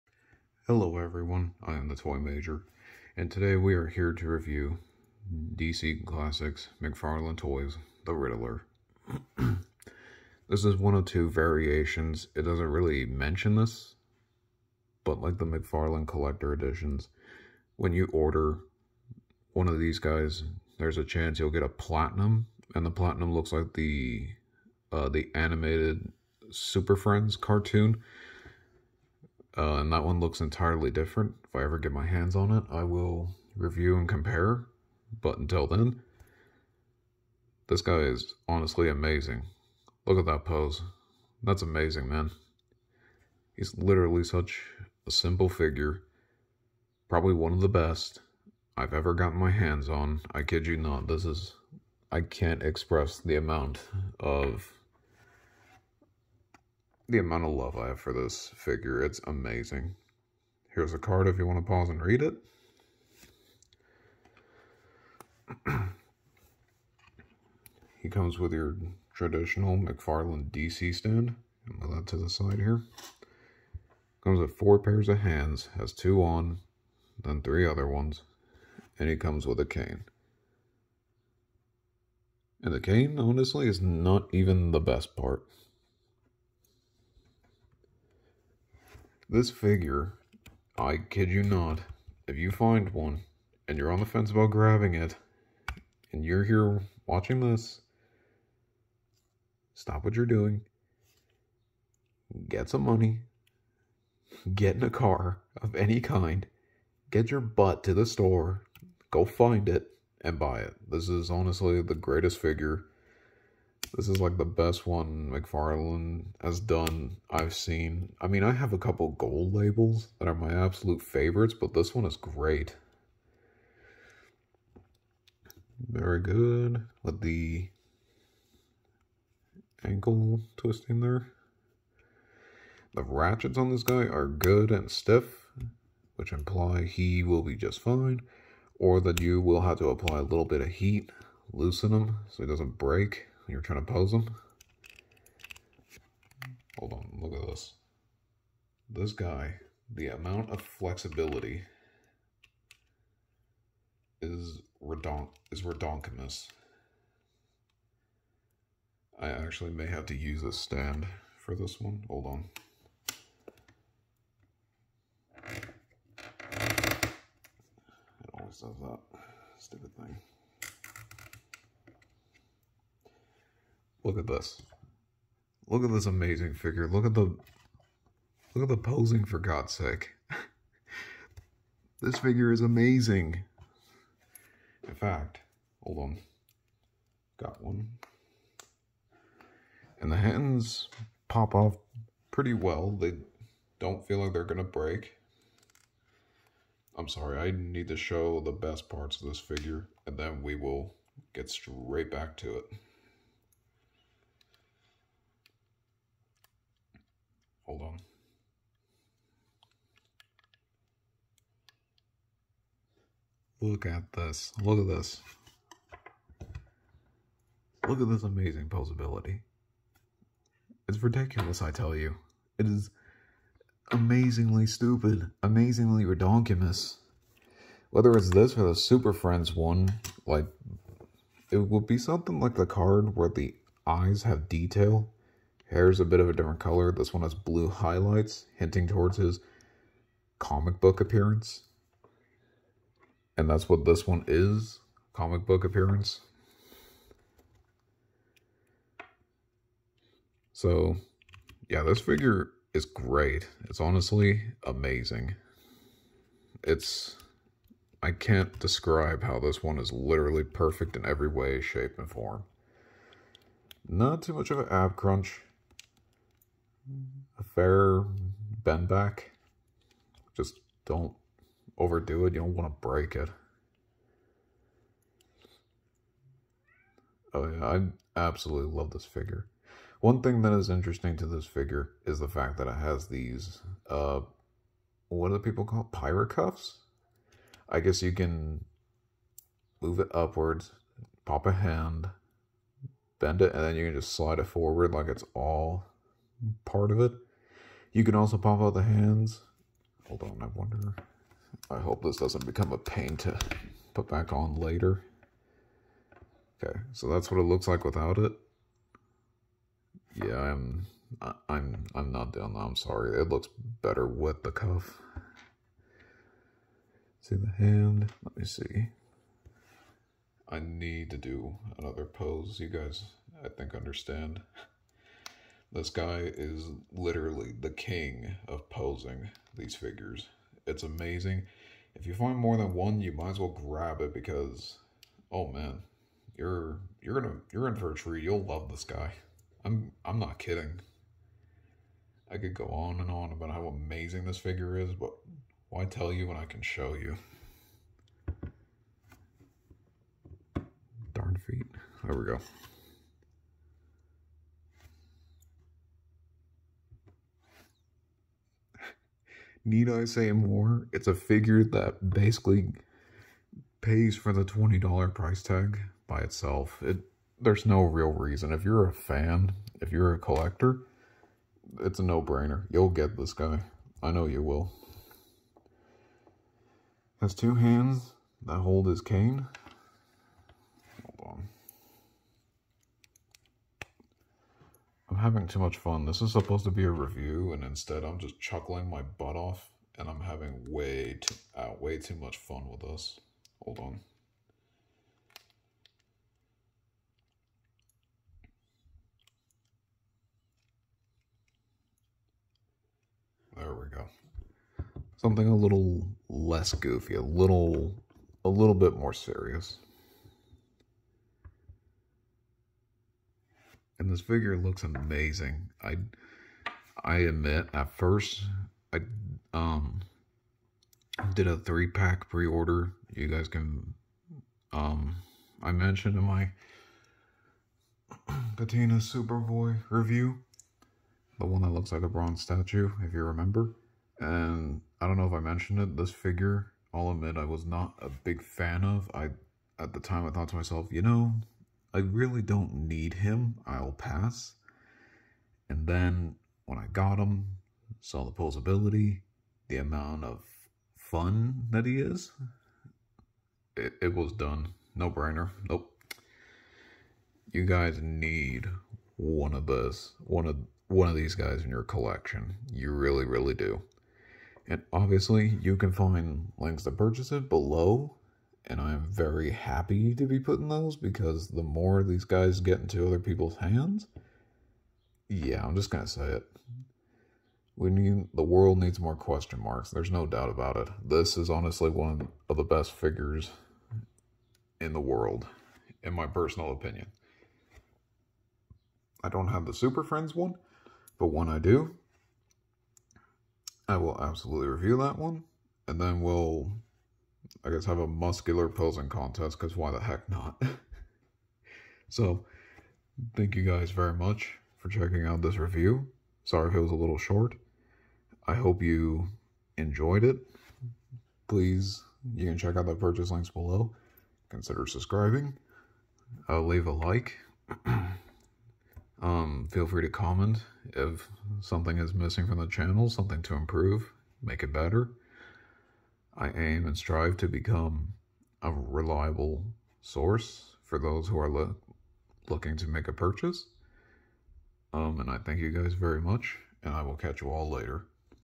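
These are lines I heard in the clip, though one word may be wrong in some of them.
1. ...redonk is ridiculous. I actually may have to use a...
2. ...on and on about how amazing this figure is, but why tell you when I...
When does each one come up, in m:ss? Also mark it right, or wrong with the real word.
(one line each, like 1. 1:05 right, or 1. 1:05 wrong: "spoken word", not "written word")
1. 2:34 wrong: "redonkulous", not "ridiculous"
2. 5:42 right.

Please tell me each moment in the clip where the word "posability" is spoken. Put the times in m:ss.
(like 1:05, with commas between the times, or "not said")
3:38, 7:28.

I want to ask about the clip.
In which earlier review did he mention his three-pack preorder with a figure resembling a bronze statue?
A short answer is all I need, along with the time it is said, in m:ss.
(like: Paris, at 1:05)
Patina Superboy, at 7:08.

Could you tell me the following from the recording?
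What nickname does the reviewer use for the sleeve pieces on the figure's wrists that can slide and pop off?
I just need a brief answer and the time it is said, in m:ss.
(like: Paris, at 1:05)
Pirate cuffs, at 4:45.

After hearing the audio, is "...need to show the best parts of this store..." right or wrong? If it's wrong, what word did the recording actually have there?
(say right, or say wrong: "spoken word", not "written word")
wrong: "figure", not "store".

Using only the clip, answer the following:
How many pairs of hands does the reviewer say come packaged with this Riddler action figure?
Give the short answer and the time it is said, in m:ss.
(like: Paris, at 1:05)
4, at 1:14.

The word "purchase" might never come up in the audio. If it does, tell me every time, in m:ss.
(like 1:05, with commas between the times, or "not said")
7:46, 8:32, 8:53.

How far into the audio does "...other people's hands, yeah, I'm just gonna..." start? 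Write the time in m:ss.
7:53.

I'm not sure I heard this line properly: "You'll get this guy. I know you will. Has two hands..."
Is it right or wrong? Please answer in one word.
right.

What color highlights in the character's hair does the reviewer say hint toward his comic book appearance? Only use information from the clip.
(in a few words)
Blue.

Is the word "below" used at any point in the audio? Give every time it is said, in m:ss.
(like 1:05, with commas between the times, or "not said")
7:47, 8:33.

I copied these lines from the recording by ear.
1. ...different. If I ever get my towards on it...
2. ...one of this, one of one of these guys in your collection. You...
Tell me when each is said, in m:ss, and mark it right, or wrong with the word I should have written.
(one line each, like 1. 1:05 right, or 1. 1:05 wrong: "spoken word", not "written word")
1. 0:30 wrong: "hands", not "towards"
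2. 7:39 right.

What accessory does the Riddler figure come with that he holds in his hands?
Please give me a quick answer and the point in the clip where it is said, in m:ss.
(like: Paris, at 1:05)
A cane, at 1:19.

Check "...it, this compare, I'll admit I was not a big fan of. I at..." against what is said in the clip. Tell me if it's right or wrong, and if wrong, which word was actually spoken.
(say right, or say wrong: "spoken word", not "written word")
wrong: "figure", not "compare".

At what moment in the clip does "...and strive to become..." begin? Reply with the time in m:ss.
8:46.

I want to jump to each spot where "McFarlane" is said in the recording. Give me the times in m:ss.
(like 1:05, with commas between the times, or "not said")
0:06, 0:15, 1:09, 1:55.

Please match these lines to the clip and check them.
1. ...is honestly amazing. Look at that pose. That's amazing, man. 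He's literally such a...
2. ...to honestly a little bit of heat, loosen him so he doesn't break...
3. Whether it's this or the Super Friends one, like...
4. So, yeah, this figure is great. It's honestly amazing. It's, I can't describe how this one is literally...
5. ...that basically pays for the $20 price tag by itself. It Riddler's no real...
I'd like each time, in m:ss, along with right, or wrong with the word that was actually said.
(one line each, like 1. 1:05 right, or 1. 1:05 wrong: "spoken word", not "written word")
1. 0:37 right
2. 2:19 wrong: "apply", not "honestly"
3. 3:47 right
4. 4:10 right
5. 6:01 wrong: "There", not "Riddler".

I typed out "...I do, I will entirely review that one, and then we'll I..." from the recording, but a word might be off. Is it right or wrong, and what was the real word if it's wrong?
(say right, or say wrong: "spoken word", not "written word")
wrong: "absolutely", not "entirely".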